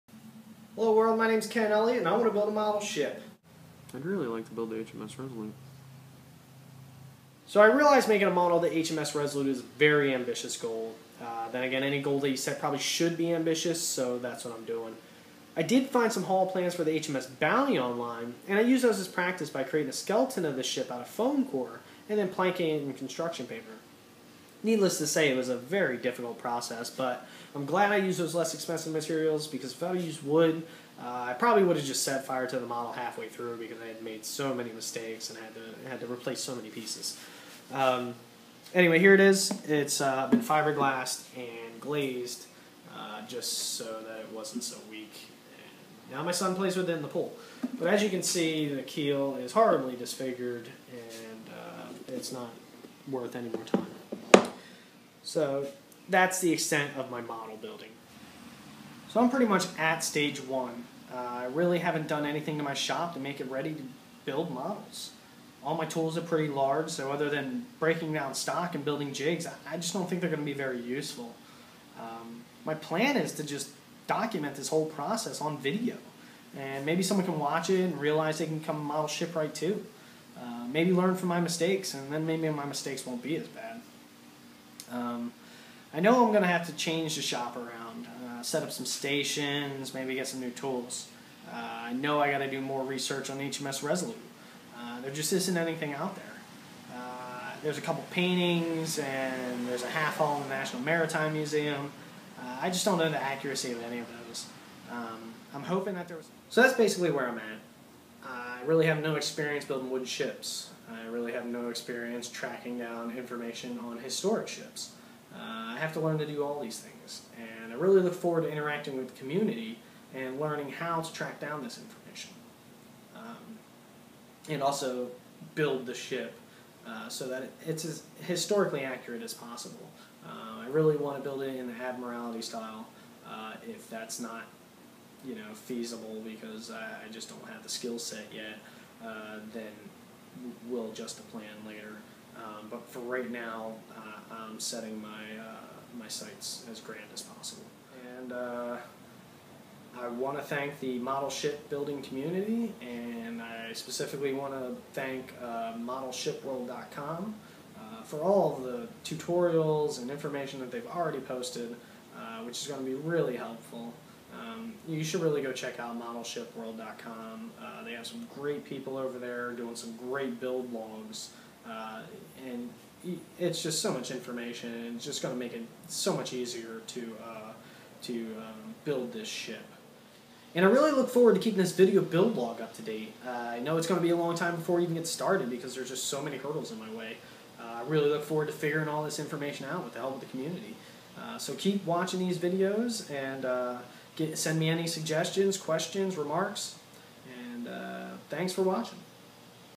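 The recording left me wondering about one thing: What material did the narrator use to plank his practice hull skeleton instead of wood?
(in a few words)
construction paper.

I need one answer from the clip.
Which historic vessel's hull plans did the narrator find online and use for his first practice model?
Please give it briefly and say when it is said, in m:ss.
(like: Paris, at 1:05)
HMS Bounty, at 0:16.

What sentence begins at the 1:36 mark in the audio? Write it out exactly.
Uh, there's a couple paintings, and there's a half hull in the National Maritime Museum.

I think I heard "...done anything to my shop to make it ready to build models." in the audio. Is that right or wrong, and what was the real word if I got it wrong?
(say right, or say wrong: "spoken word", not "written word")
right.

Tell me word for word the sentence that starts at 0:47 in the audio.
But as you can see, the keel is horribly disfigured and uh, it's not worth any more time.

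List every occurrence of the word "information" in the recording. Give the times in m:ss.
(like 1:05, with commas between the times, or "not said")
1:53, 2:01, 2:40, 2:54, 3:09.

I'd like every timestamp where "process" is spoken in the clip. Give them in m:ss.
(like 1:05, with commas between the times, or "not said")
0:26, 1:14.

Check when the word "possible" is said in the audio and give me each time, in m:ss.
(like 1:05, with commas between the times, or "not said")
2:09, 2:27.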